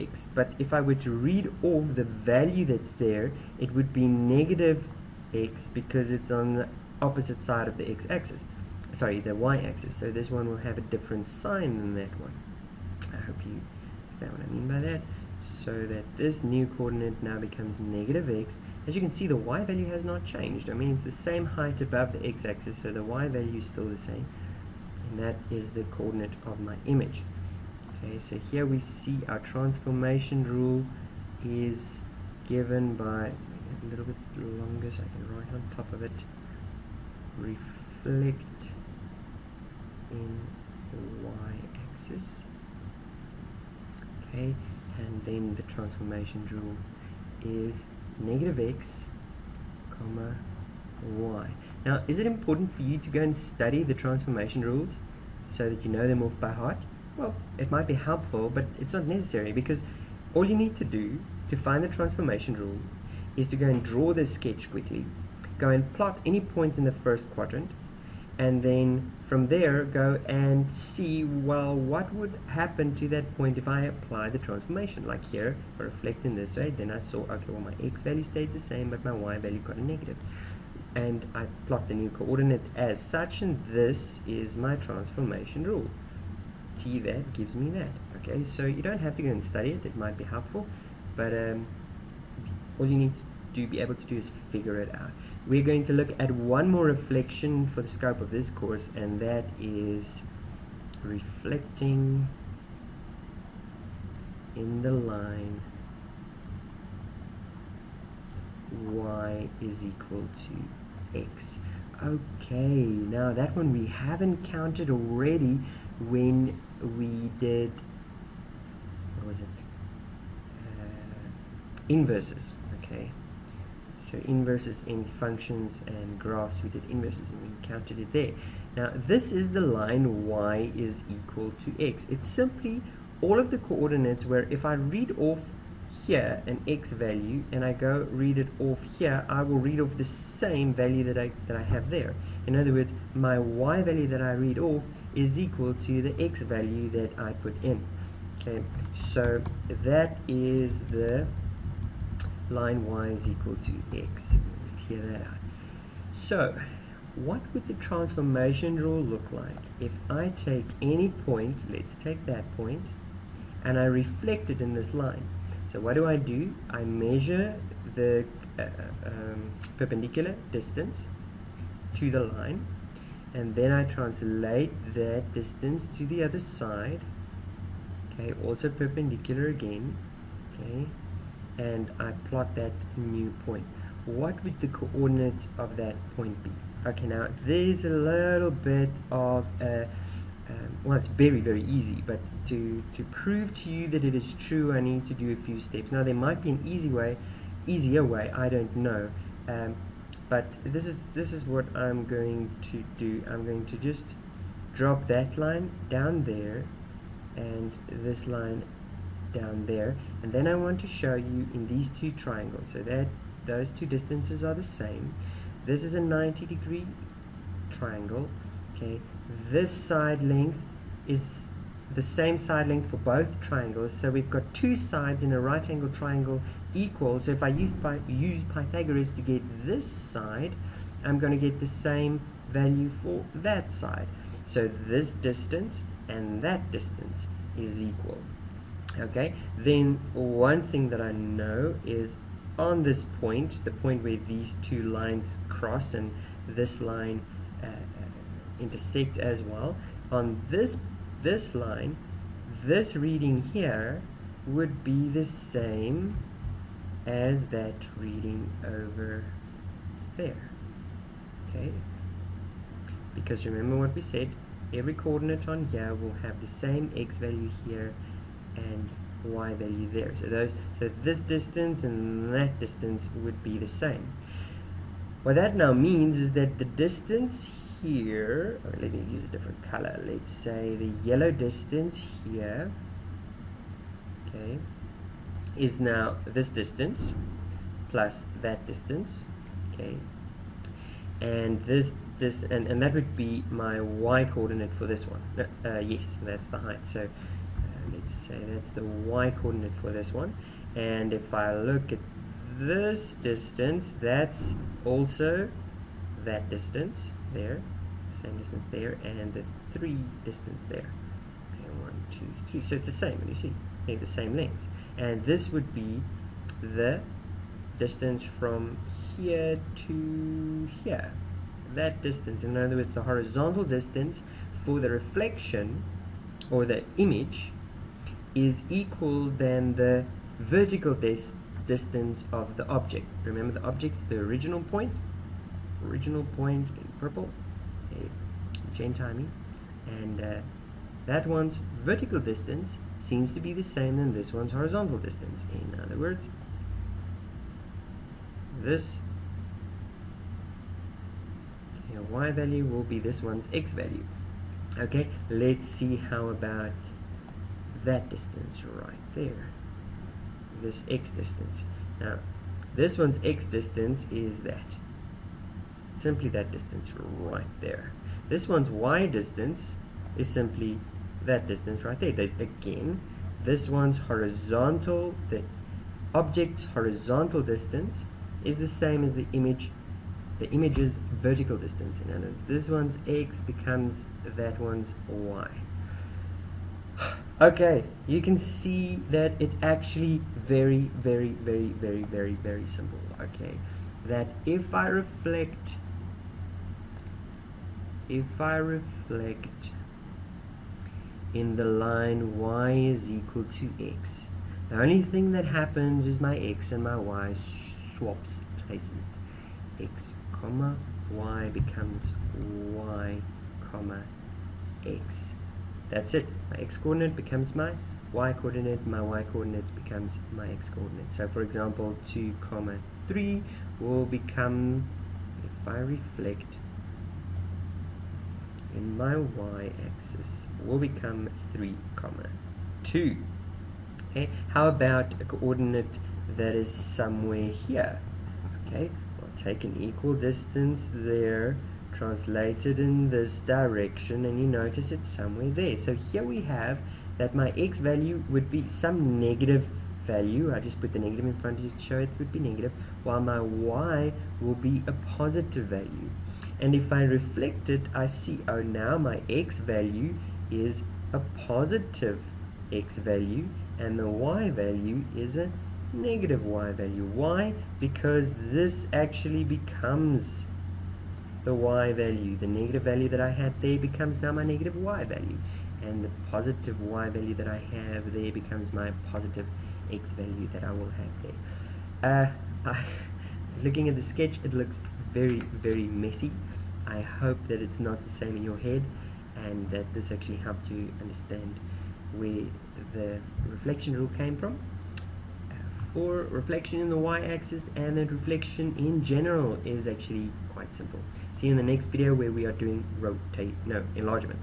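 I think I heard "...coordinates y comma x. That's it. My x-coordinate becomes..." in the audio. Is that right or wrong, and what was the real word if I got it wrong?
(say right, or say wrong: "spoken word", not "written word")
wrong: "becomes", not "coordinates".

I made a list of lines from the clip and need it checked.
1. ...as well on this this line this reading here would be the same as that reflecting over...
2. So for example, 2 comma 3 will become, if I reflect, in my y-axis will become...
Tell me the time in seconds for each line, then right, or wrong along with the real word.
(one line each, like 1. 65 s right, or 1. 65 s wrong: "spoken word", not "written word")
1. 249 s wrong: "reading", not "reflecting"
2. 421 s right.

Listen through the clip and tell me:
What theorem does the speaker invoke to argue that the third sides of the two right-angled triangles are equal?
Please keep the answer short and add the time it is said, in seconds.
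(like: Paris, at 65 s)
Pythagoras, at 228 s.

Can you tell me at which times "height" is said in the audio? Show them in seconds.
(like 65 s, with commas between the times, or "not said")
21 s, 296 s.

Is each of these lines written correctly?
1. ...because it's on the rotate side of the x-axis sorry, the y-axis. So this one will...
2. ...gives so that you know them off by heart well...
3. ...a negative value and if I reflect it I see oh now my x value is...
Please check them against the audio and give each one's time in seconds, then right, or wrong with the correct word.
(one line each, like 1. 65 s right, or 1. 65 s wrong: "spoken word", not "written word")
1. 5 s wrong: "opposite", not "rotate"
2. 54 s wrong: "rules", not "gives"
3. 454 s wrong: "positive", not "negative".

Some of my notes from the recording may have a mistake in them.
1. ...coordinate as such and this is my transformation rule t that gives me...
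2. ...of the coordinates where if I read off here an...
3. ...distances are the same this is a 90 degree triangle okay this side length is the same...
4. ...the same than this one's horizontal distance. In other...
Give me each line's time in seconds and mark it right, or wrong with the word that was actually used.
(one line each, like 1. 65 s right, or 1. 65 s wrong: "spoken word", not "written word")
1. 82 s right
2. 133 s right
3. 213 s right
4. 343 s right.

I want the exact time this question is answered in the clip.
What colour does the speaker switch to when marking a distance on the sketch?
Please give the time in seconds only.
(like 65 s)
281 s.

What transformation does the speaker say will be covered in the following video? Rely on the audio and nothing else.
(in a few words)
rotate.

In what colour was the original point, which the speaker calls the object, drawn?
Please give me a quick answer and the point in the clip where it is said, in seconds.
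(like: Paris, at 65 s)
purple, at 336 s.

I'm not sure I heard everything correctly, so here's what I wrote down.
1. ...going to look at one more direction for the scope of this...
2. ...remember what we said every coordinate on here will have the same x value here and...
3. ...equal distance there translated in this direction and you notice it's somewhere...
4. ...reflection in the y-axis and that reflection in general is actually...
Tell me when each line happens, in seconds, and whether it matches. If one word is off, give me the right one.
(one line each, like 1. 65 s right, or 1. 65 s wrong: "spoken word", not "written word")
1. 95 s wrong: "reflection", not "direction"
2. 263 s right
3. 439 s right
4. 496 s right.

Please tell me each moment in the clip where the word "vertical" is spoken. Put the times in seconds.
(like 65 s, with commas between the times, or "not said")
330 s, 341 s, 381 s.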